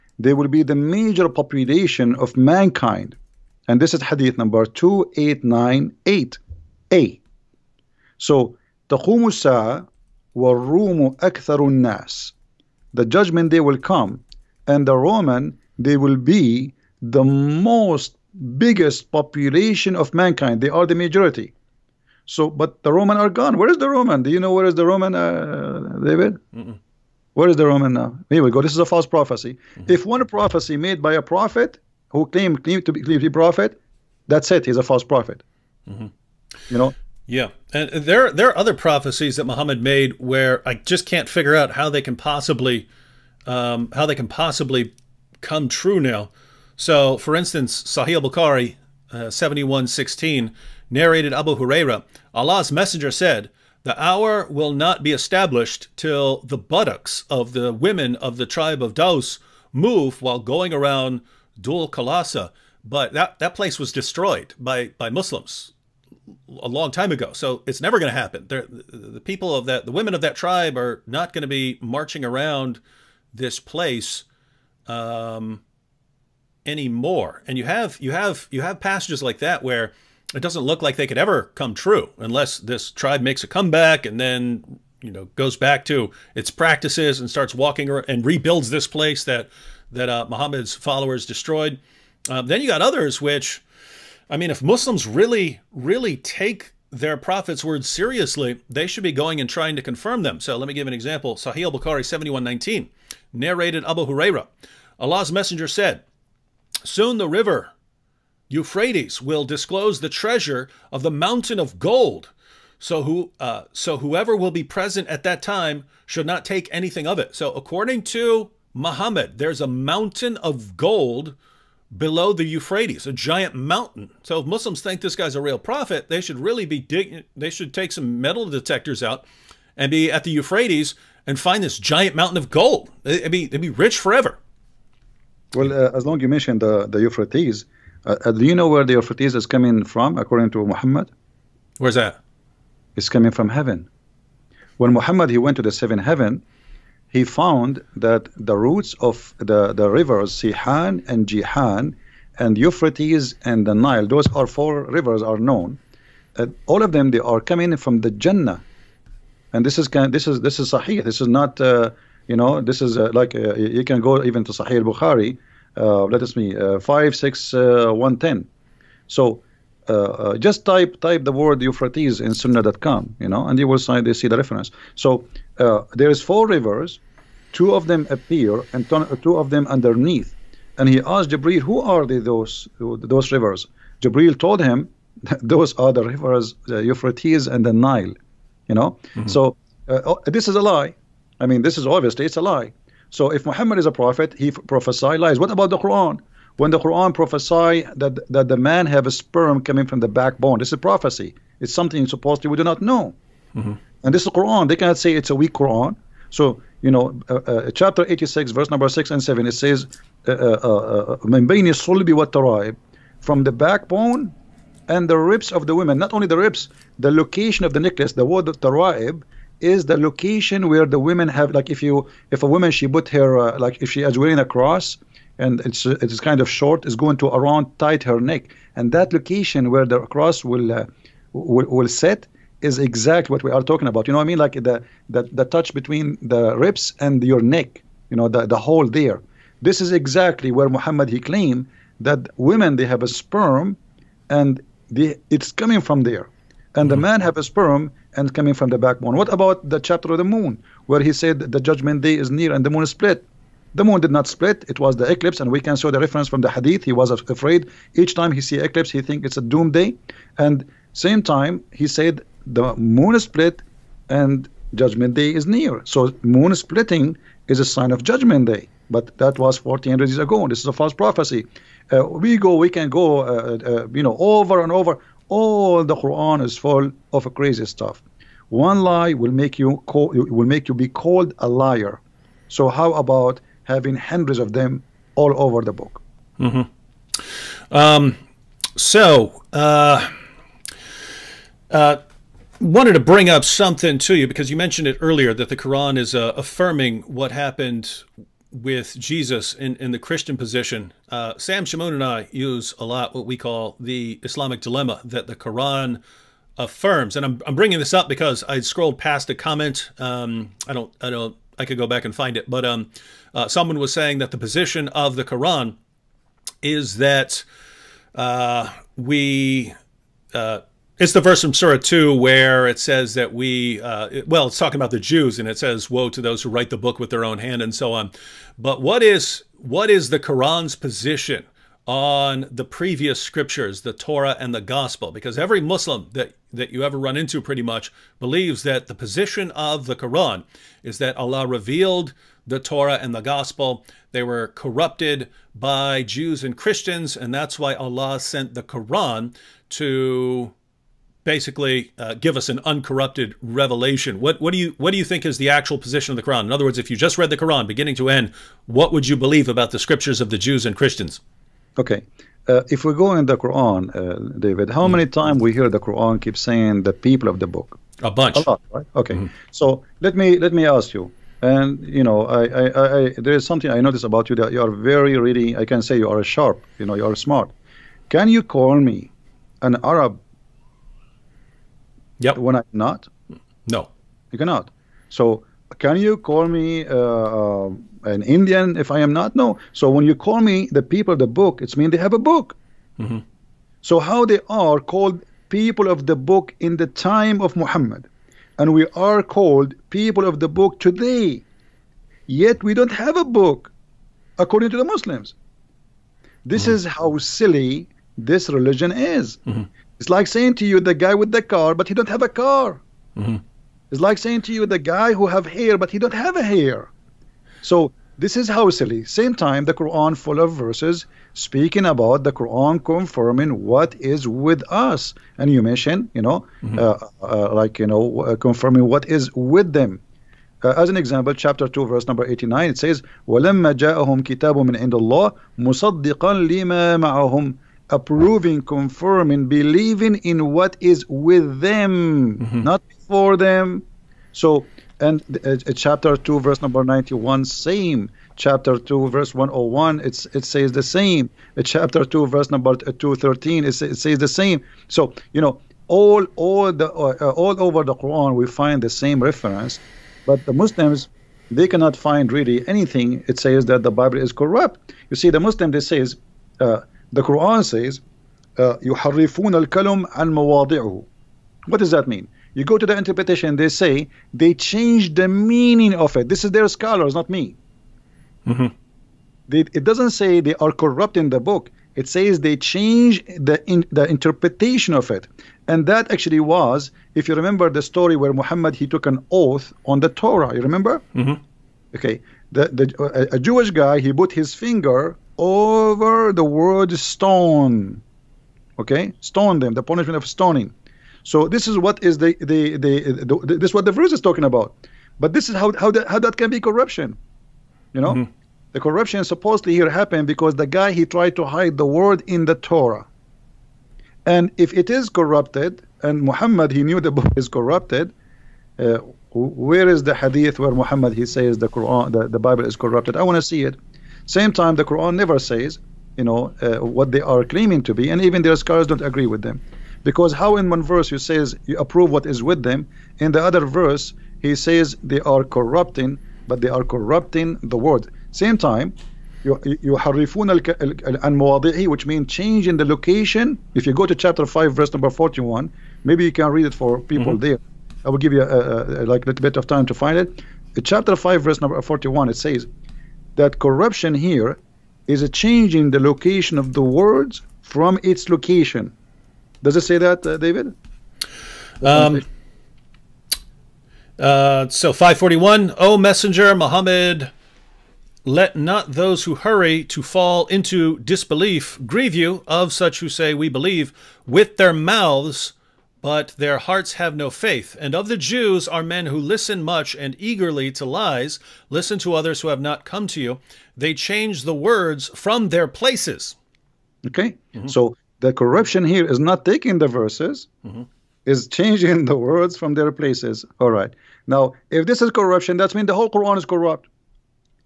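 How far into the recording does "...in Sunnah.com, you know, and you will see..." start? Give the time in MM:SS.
02:52.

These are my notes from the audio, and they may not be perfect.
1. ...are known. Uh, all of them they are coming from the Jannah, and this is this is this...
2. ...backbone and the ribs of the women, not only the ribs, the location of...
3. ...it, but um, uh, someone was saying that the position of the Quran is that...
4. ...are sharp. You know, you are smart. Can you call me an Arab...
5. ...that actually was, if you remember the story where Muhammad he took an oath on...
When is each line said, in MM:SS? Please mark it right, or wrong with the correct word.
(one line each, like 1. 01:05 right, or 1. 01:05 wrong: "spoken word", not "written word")
1. 02:35 right
2. 03:33 right
3. 05:12 right
4. 06:16 right
5. 08:05 right.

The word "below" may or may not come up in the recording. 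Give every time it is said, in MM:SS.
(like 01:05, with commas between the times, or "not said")
02:01.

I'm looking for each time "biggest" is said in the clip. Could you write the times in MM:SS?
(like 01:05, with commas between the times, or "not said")
00:18.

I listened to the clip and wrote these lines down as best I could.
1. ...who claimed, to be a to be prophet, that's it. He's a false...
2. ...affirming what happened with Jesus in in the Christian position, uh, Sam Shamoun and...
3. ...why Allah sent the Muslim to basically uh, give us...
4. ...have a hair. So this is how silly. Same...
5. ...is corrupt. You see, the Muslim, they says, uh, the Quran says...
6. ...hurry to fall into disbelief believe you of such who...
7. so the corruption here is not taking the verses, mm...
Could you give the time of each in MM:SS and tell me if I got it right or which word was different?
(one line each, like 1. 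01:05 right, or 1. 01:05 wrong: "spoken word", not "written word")
1. 00:32 right
2. 04:56 right
3. 05:47 wrong: "Quran", not "Muslim"
4. 06:56 right
5. 07:44 right
6. 09:29 wrong: "grieve", not "believe"
7. 09:47 right.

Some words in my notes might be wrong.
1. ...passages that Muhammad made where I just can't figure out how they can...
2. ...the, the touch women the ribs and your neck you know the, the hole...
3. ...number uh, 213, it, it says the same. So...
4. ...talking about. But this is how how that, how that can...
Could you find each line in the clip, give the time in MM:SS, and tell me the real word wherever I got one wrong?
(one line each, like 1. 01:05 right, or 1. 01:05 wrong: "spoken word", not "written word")
1. 00:38 wrong: "prophecies", not "passages"
2. 03:55 wrong: "between", not "women"
3. 07:32 right
4. 08:24 right.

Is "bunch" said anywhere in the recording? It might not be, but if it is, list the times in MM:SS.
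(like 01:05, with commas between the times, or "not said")
06:08.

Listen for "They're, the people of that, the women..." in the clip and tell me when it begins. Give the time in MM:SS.
01:08.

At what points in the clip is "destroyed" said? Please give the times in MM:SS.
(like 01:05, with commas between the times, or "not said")
01:03, 01:31.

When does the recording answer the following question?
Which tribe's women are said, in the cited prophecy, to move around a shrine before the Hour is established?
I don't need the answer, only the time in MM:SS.
00:58.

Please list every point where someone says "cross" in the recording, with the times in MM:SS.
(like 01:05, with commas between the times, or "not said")
03:44, 03:50.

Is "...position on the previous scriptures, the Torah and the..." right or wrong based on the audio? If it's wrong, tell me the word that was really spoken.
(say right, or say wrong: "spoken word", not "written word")
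right.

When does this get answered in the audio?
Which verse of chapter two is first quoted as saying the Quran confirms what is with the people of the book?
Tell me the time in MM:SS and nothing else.
07:12.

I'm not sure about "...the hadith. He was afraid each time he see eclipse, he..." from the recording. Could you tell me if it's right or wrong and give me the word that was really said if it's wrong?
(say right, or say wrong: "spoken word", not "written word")
right.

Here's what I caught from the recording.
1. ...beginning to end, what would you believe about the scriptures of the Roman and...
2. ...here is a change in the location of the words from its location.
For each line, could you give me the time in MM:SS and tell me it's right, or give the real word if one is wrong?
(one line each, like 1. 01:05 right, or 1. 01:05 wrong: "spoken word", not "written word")
1. 05:57 wrong: "Jews", not "Roman"
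2. 09:14 right.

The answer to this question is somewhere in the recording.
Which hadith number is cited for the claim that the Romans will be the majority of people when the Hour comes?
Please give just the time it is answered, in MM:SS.
00:04.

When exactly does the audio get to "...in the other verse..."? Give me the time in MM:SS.
08:53.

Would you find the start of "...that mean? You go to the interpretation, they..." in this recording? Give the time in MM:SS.
07:51.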